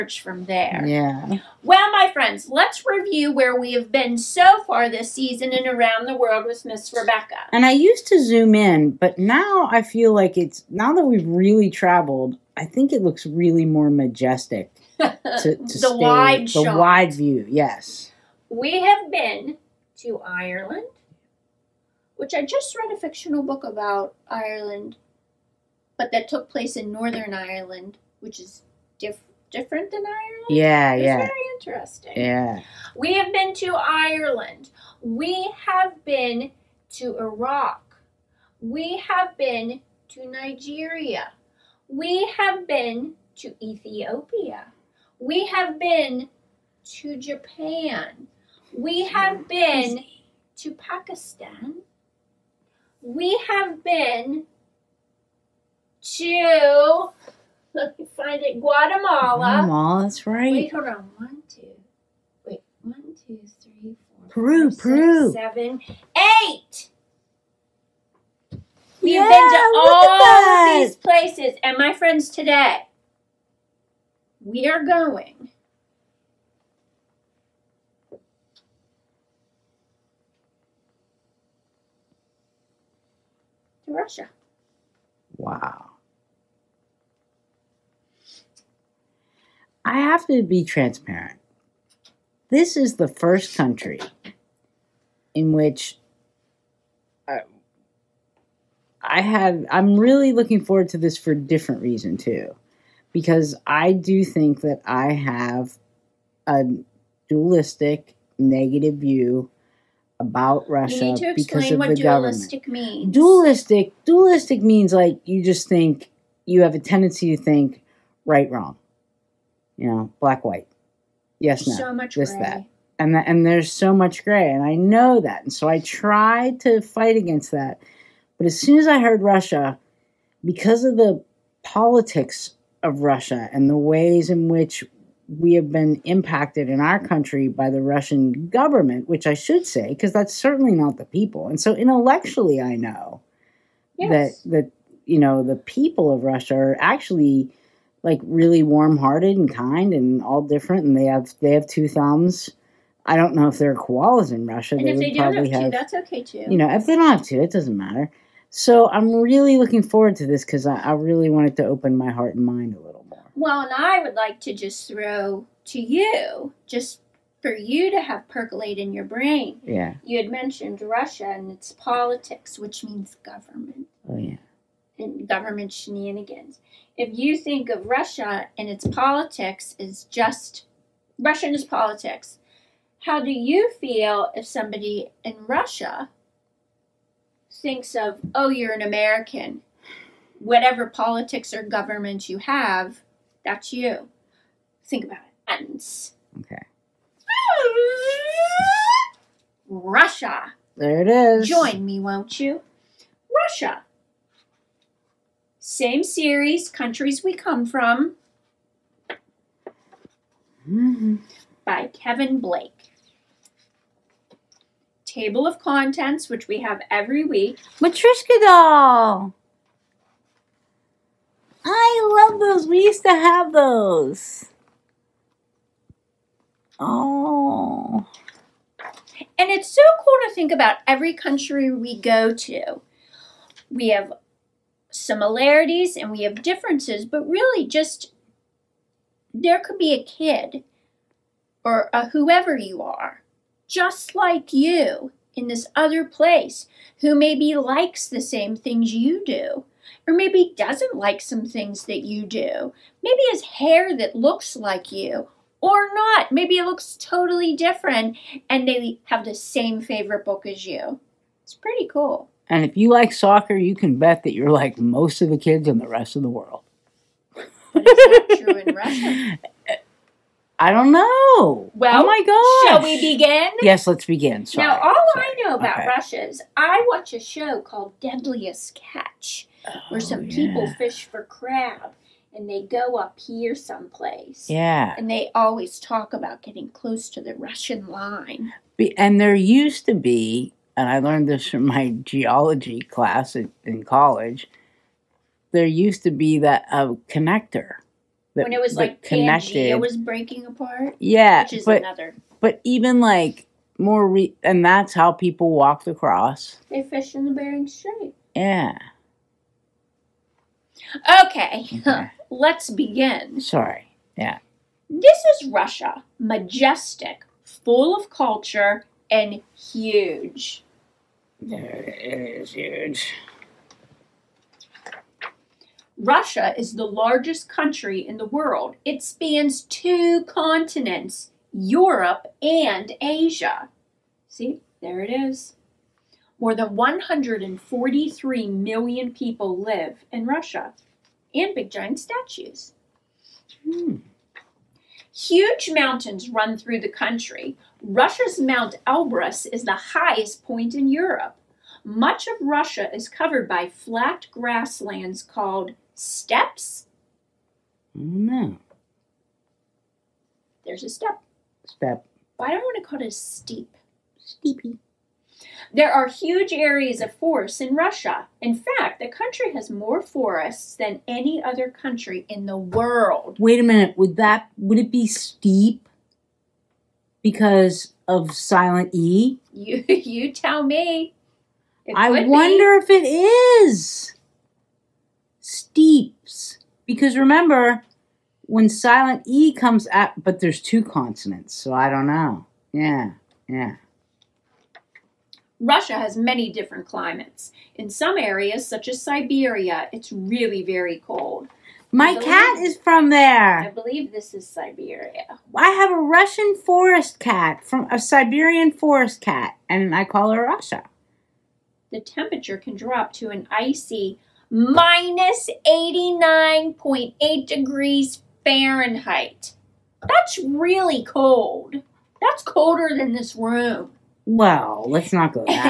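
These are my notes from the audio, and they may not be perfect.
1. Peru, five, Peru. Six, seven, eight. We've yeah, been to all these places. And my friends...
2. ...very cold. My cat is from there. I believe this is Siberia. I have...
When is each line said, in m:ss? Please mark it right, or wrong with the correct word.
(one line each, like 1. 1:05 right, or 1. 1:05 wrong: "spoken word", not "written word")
1. 1:04 right
2. 6:40 right.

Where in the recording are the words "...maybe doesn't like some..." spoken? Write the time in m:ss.
4:10.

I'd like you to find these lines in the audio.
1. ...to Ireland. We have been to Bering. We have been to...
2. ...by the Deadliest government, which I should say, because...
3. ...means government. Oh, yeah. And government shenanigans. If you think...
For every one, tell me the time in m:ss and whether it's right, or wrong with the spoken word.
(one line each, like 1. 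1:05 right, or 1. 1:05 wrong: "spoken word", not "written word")
1. 0:33 wrong: "Iraq", not "Bering"
2. 2:17 wrong: "Russian", not "Deadliest"
3. 2:52 right.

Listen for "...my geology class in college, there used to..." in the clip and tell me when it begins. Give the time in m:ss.
4:51.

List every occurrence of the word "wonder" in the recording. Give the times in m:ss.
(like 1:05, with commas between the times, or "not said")
6:22.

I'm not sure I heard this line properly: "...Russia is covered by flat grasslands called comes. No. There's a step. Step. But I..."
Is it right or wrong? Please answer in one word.
wrong.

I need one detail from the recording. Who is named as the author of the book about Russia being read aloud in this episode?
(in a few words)
Kevin Blake.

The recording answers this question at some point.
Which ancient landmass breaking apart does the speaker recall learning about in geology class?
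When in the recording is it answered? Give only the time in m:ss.
4:59.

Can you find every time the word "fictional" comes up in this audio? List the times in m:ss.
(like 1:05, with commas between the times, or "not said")
0:22.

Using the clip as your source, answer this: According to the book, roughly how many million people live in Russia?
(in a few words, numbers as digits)
143 million.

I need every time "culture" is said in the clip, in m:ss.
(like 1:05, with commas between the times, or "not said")
5:18.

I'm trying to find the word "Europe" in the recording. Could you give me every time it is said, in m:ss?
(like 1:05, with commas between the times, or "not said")
5:31, 5:50.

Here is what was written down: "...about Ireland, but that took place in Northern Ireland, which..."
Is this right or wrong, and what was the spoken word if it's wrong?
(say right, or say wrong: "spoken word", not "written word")
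right.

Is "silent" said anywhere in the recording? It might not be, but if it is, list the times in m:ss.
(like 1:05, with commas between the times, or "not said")
6:18, 6:28.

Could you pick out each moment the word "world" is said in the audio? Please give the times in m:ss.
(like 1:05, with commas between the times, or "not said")
0:06, 4:26, 5:28, 6:12.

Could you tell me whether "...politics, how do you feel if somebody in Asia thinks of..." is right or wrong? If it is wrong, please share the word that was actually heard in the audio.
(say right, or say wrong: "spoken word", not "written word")
wrong: "Russia", not "Asia".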